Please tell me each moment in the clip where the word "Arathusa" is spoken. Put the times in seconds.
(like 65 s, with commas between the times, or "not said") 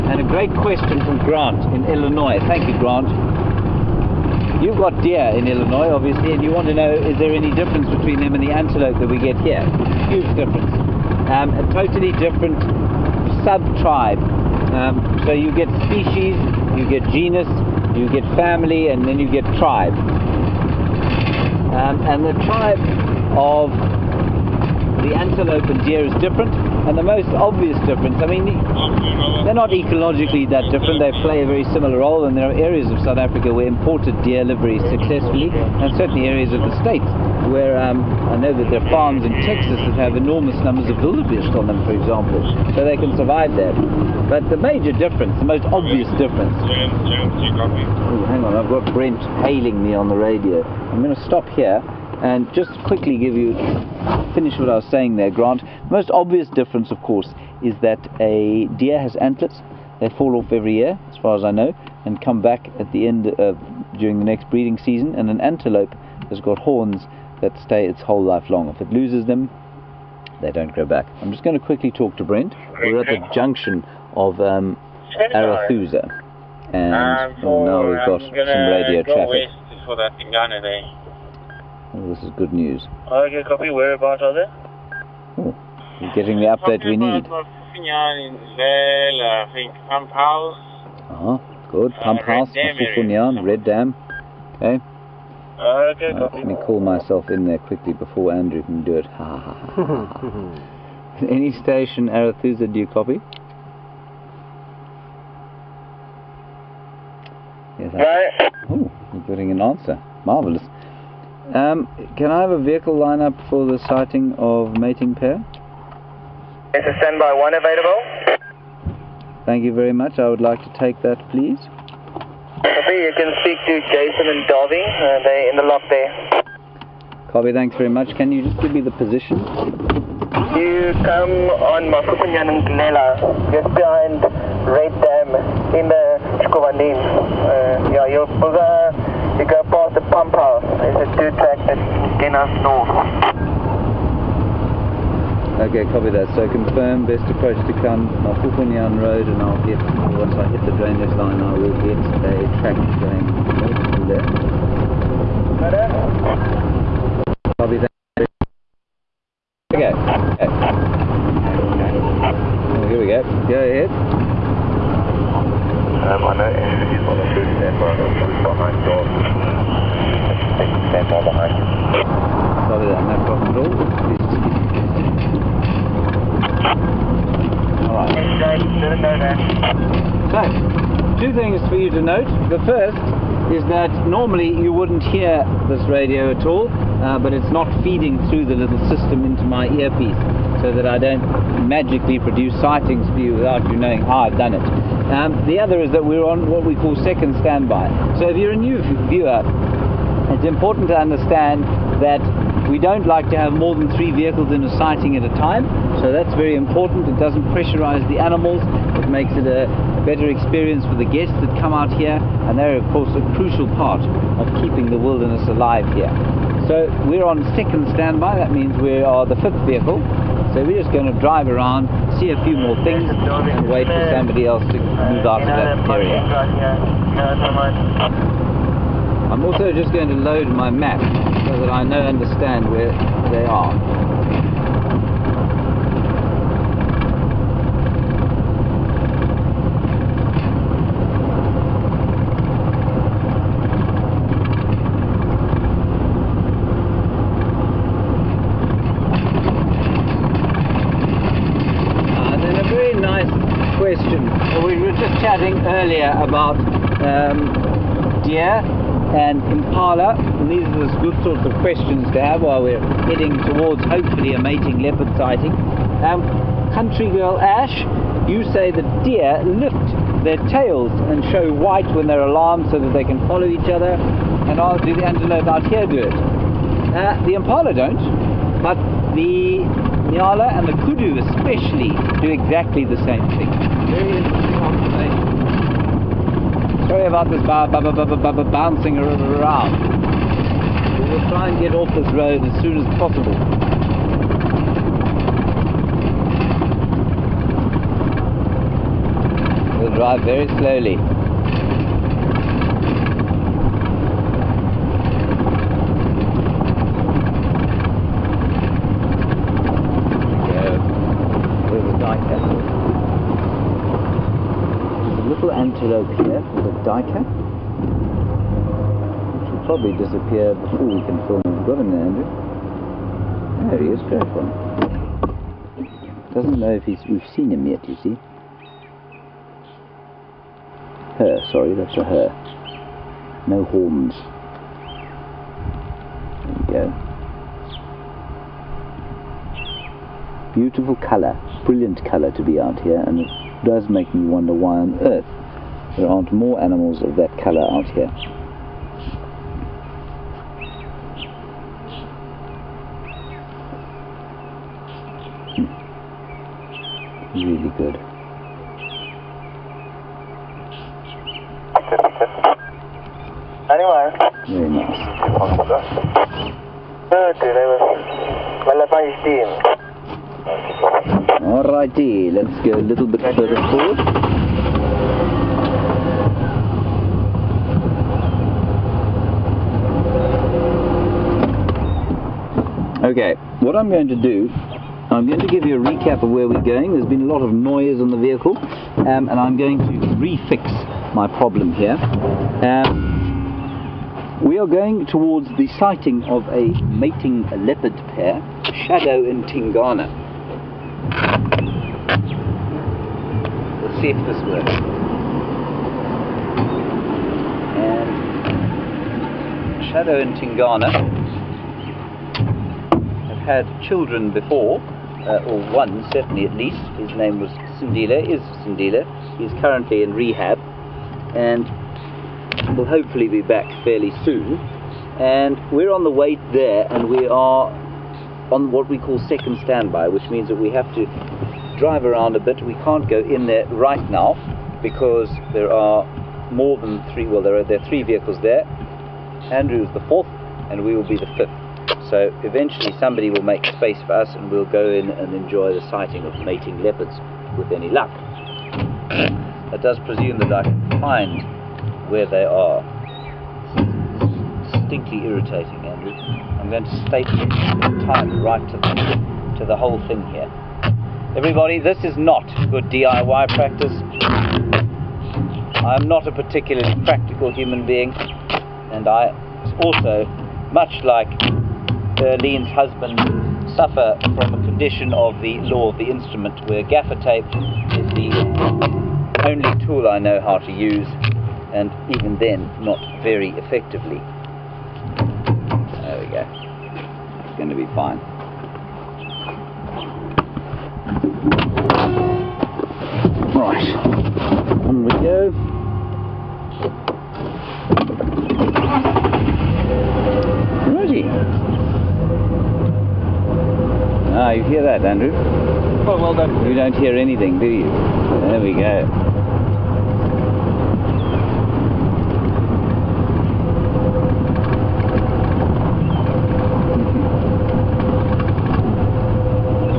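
75 s, 102 s.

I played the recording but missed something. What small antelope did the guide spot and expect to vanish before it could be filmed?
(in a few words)
Duiker.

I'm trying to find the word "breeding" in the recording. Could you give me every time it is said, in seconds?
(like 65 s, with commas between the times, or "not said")
64 s.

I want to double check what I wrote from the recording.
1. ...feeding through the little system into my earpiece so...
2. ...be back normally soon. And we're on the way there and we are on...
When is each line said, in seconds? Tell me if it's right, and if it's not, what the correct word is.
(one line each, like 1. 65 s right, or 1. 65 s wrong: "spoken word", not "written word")
1. 187 s right
2. 423 s wrong: "fairly", not "normally".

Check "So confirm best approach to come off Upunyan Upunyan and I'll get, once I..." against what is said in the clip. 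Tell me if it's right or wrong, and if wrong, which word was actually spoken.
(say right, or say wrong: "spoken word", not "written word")
wrong: "Road", not "Upunyan".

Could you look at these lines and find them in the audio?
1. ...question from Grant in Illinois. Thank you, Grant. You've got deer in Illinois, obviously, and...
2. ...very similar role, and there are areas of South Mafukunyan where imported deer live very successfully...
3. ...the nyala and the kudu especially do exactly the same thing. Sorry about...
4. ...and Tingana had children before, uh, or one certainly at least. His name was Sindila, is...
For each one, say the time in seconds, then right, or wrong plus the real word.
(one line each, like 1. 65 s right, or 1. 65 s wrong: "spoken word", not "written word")
1. 0 s right
2. 31 s wrong: "Africa", not "Mafukunyan"
3. 279 s right
4. 410 s right.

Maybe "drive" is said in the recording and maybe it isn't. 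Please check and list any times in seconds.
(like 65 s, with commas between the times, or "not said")
221 s, 299 s, 431 s.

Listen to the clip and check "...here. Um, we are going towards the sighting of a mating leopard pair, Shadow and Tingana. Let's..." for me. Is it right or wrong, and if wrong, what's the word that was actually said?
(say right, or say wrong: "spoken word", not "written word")
right.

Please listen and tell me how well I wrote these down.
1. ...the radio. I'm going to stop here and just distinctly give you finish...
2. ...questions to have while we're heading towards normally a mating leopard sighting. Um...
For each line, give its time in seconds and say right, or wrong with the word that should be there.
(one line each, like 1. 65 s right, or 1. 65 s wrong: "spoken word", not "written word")
1. 50 s wrong: "quickly", not "distinctly"
2. 261 s wrong: "hopefully", not "normally".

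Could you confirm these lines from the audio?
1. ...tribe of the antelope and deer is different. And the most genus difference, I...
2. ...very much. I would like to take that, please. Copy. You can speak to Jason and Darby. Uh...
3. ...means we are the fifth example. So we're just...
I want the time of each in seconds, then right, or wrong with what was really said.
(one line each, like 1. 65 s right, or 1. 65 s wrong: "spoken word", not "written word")
1. 22 s wrong: "obvious", not "genus"
2. 119 s right
3. 218 s wrong: "vehicle", not "example".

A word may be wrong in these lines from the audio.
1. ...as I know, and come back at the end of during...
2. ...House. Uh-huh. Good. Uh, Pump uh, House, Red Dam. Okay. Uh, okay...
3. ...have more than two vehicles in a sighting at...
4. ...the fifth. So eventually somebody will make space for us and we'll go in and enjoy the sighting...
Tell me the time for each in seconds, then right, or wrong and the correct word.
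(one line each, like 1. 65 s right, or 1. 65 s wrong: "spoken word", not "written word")
1. 61 s right
2. 90 s right
3. 203 s wrong: "three", not "two"
4. 441 s right.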